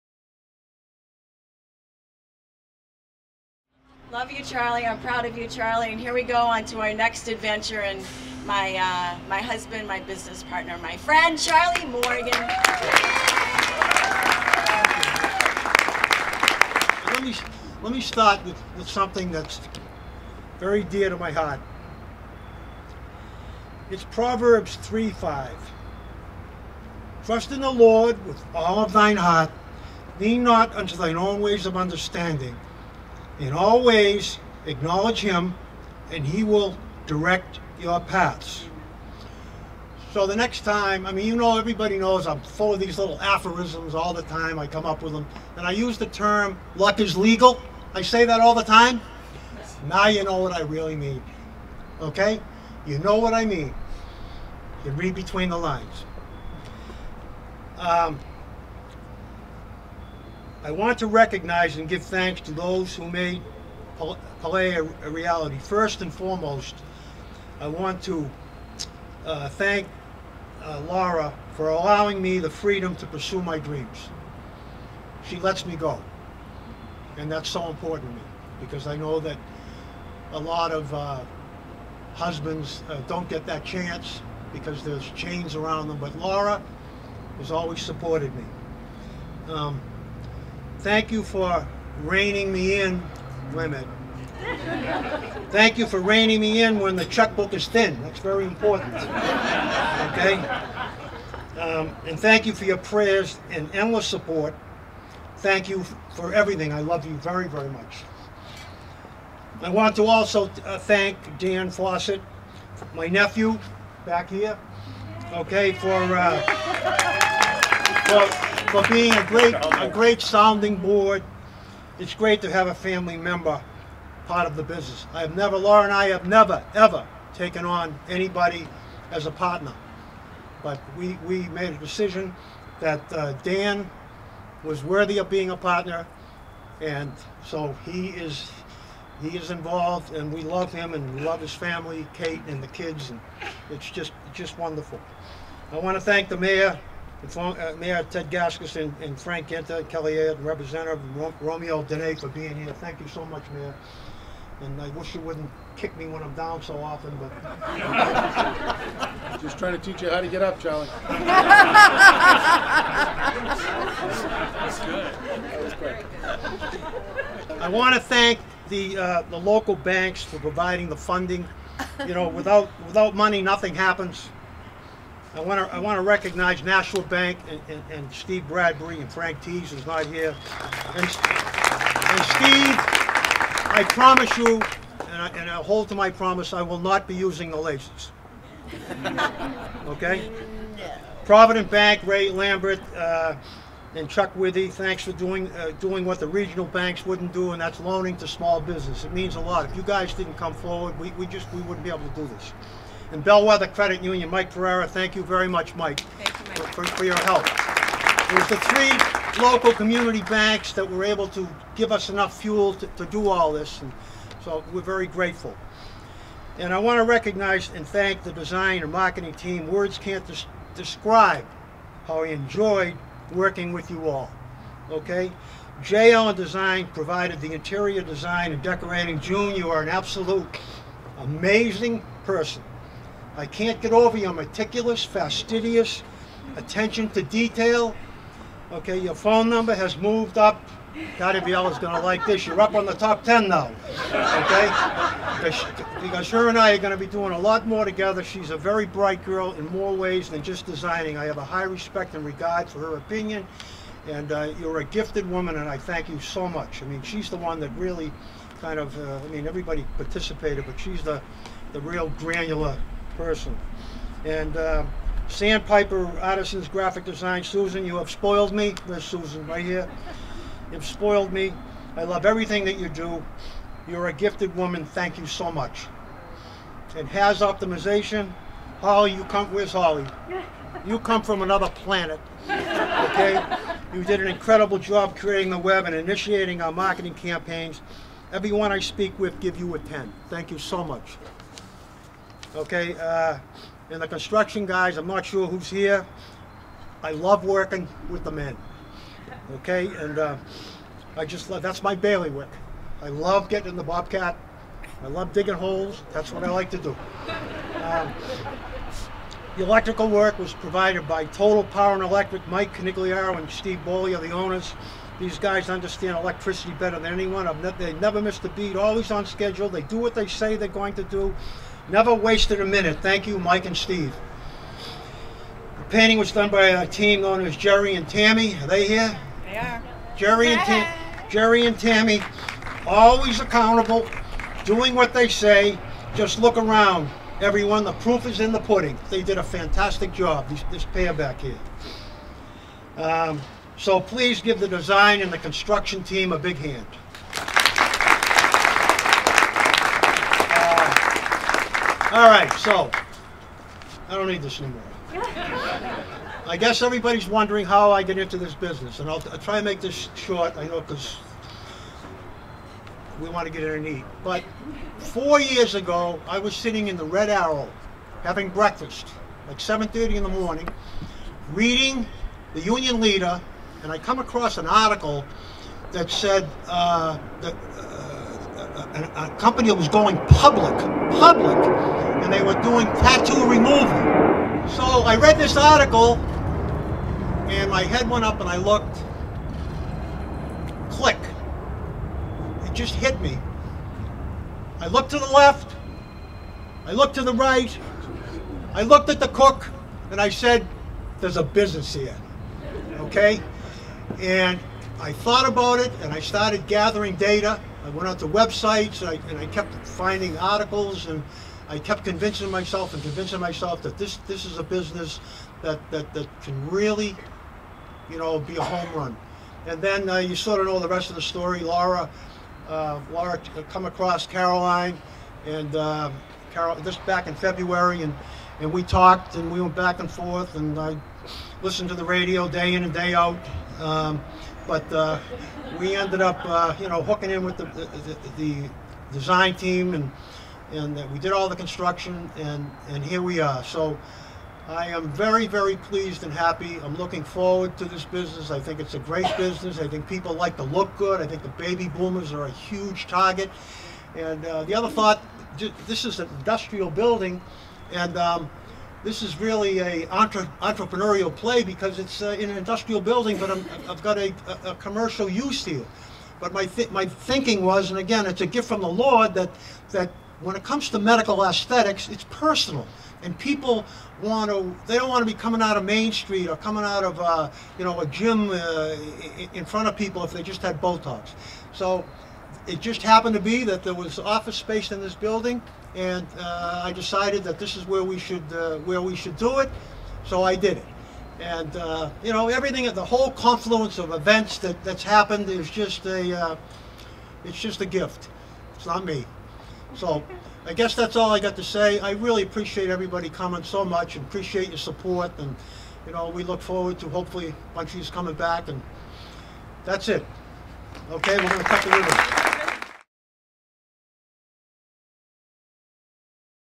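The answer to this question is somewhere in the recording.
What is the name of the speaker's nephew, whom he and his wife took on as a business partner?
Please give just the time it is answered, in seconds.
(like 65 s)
111 s.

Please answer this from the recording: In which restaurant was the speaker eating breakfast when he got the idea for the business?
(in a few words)
Red Arrow.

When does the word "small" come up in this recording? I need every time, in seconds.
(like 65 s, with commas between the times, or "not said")
198 s.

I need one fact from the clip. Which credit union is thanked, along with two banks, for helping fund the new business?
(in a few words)
Bellwether Credit Union.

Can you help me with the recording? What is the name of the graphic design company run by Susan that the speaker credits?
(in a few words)
Sandpiper Artisans.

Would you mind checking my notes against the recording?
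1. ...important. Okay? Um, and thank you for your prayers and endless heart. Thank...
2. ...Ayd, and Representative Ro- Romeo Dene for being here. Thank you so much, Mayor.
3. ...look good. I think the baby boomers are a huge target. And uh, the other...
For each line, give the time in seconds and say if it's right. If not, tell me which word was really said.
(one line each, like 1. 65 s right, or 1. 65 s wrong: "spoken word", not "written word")
1. 98 s wrong: "support", not "heart"
2. 150 s right
3. 450 s right.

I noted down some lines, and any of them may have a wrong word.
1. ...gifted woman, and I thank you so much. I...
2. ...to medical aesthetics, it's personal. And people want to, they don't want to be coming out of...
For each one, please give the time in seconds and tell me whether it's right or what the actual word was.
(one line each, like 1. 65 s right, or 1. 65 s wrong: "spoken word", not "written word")
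1. 254 s right
2. 470 s right.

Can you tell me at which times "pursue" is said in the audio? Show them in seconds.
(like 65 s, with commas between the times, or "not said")
73 s.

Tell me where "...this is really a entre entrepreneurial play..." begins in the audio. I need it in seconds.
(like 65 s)
459 s.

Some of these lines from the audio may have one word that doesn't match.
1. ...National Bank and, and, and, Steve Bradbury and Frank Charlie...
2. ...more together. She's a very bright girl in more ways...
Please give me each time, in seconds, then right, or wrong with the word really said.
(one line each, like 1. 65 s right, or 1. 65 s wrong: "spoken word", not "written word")
1. 176 s wrong: "Tees", not "Charlie"
2. 247 s right.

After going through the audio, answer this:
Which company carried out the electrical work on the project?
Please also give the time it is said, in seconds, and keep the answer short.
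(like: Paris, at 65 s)
Total Power and Electric, at 311 s.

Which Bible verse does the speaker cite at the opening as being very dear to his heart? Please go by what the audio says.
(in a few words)
Proverbs 3:5.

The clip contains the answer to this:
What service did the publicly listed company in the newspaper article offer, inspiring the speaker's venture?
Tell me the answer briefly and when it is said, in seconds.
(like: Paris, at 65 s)
tattoo removal, at 382 s.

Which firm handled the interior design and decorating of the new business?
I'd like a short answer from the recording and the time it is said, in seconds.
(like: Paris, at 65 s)
JL Design, at 225 s.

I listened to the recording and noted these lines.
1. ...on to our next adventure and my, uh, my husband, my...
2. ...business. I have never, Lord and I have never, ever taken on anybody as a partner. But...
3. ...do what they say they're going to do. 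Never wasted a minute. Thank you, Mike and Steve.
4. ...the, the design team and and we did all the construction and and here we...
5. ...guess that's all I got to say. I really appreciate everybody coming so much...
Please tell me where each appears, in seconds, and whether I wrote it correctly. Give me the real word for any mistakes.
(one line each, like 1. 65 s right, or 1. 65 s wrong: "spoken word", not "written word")
1. 6 s right
2. 124 s wrong: "Laura", not "Lord"
3. 319 s right
4. 437 s right
5. 500 s right.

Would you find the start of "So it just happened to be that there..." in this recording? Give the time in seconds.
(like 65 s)
481 s.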